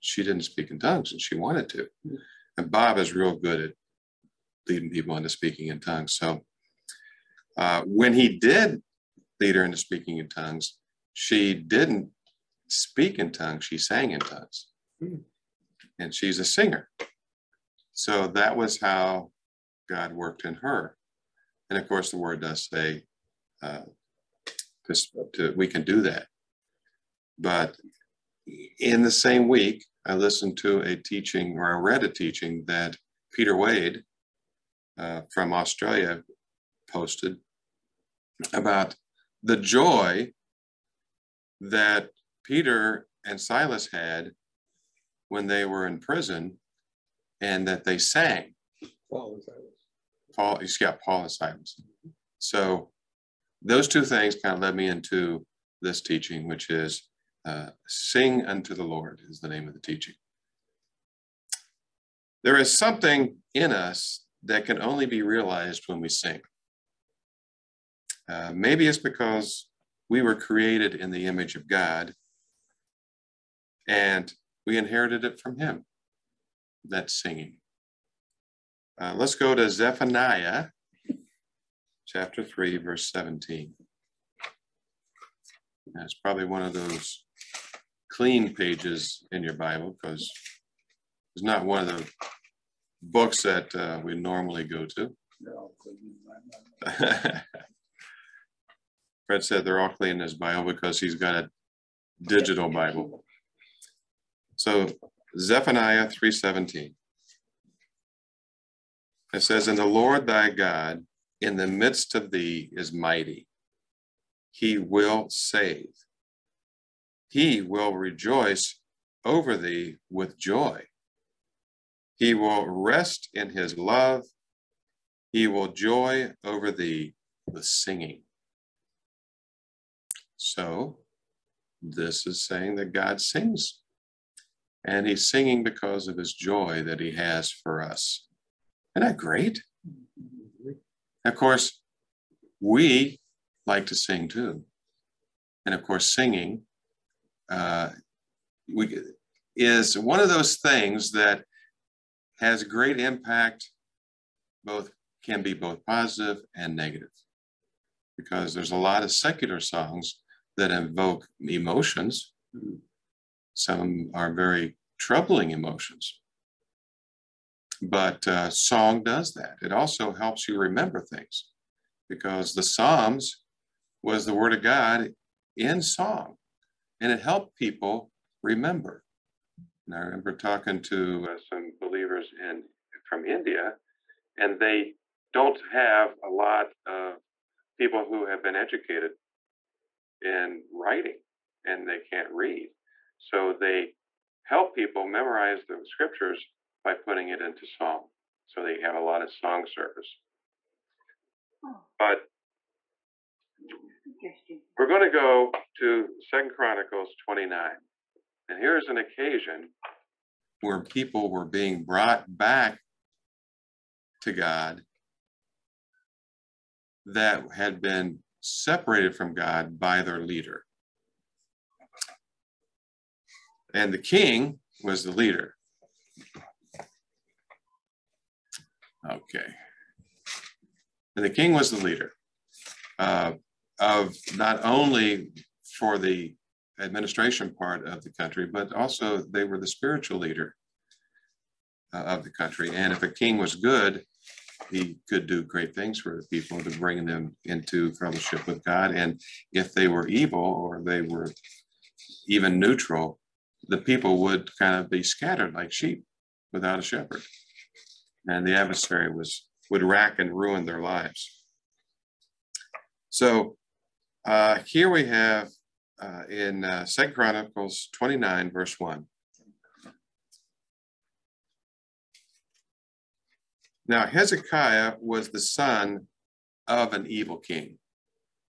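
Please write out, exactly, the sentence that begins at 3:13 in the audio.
So they help people memorize the scriptures by putting it into song.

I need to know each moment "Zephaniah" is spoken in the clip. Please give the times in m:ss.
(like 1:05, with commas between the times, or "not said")
1:19, 1:45.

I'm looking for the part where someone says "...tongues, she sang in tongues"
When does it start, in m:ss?
0:13.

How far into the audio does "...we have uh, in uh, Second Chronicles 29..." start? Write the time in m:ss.
4:24.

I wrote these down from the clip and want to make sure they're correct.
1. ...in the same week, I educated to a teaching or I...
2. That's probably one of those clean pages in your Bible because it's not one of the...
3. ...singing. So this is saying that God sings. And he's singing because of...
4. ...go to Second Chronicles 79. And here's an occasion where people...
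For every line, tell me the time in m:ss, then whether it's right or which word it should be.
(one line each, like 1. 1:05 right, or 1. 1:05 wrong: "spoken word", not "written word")
1. 0:28 wrong: "listened", not "educated"
2. 1:25 right
3. 2:07 right
4. 3:25 wrong: "29", not "79".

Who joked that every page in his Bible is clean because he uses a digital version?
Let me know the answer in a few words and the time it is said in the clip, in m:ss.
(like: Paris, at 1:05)
Fred, at 1:39.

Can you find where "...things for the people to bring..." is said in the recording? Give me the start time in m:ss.
4:05.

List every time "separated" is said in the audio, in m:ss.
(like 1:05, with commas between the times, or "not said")
3:38.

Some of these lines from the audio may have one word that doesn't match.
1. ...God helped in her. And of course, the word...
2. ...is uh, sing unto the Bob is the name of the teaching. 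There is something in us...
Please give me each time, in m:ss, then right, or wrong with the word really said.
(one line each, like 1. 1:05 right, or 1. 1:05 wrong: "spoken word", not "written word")
1. 0:19 wrong: "worked", not "helped"
2. 0:56 wrong: "Lord", not "Bob".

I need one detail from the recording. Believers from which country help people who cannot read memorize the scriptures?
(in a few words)
India.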